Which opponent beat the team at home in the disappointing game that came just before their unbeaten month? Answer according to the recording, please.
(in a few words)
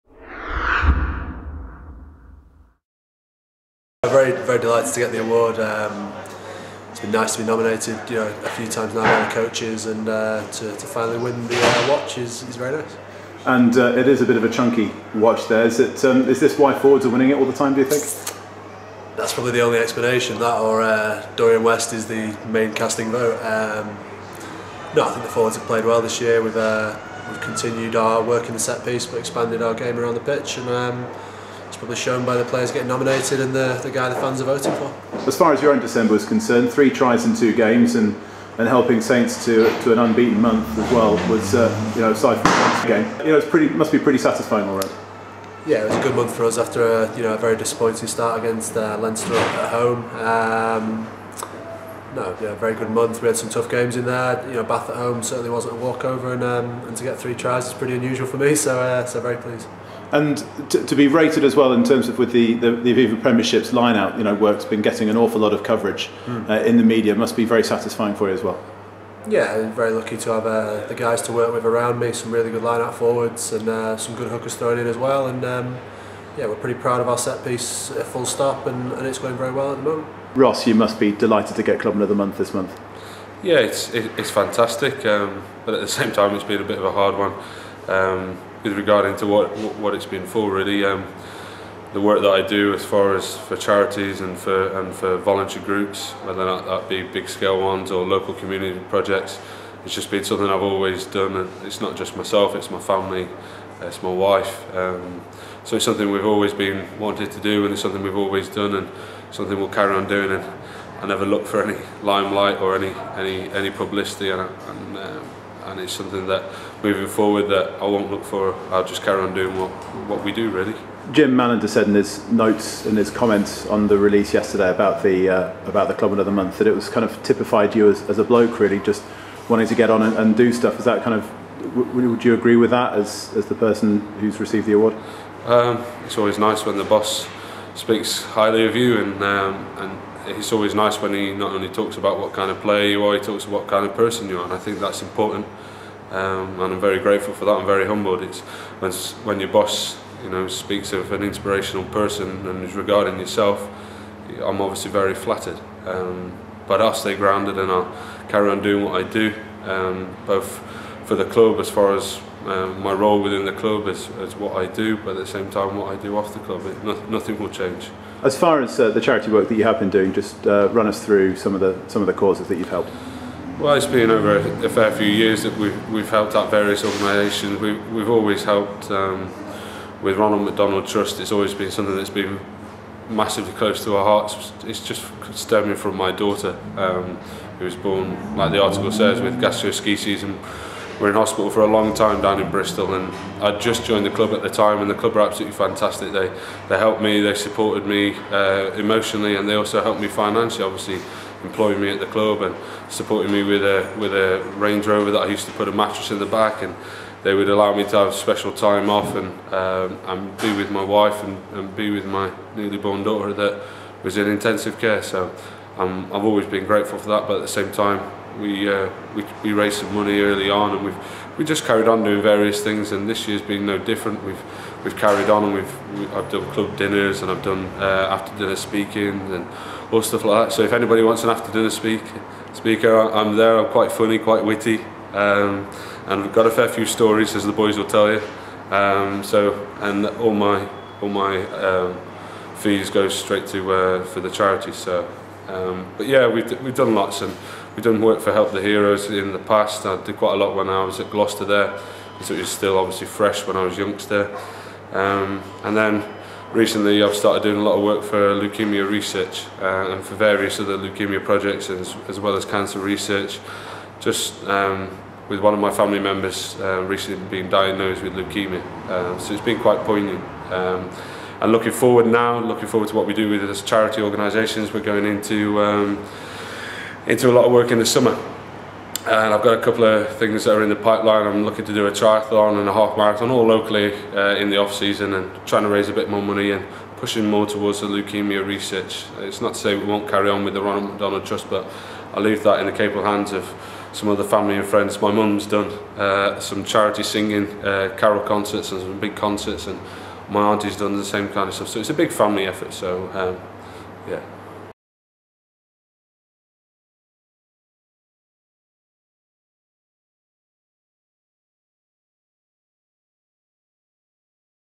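Leinster.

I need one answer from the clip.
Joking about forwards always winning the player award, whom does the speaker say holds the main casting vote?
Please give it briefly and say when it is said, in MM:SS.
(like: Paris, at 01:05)
Dorian West, at 00:21.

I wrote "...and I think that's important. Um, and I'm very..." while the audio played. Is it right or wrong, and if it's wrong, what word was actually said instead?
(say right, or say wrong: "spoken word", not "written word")
right.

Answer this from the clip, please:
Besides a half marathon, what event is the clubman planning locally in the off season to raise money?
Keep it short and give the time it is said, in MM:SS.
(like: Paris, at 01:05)
triathlon, at 04:41.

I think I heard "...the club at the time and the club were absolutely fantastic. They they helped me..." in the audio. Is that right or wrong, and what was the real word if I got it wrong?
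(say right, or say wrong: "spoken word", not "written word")
right.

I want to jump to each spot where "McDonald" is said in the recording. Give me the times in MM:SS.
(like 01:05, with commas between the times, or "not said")
03:00, 04:50.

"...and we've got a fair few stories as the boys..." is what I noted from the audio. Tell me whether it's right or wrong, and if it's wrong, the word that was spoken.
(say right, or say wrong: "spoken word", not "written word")
right.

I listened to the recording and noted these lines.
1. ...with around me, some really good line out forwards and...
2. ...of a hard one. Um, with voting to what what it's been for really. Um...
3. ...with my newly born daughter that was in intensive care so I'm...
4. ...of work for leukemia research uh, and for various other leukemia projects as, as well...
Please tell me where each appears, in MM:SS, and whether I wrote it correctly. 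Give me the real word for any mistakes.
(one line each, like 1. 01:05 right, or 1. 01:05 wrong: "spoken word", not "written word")
1. 01:11 right
2. 01:26 wrong: "regarding", not "voting"
3. 03:31 right
4. 04:17 right.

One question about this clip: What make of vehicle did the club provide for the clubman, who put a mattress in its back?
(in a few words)
Range Rover.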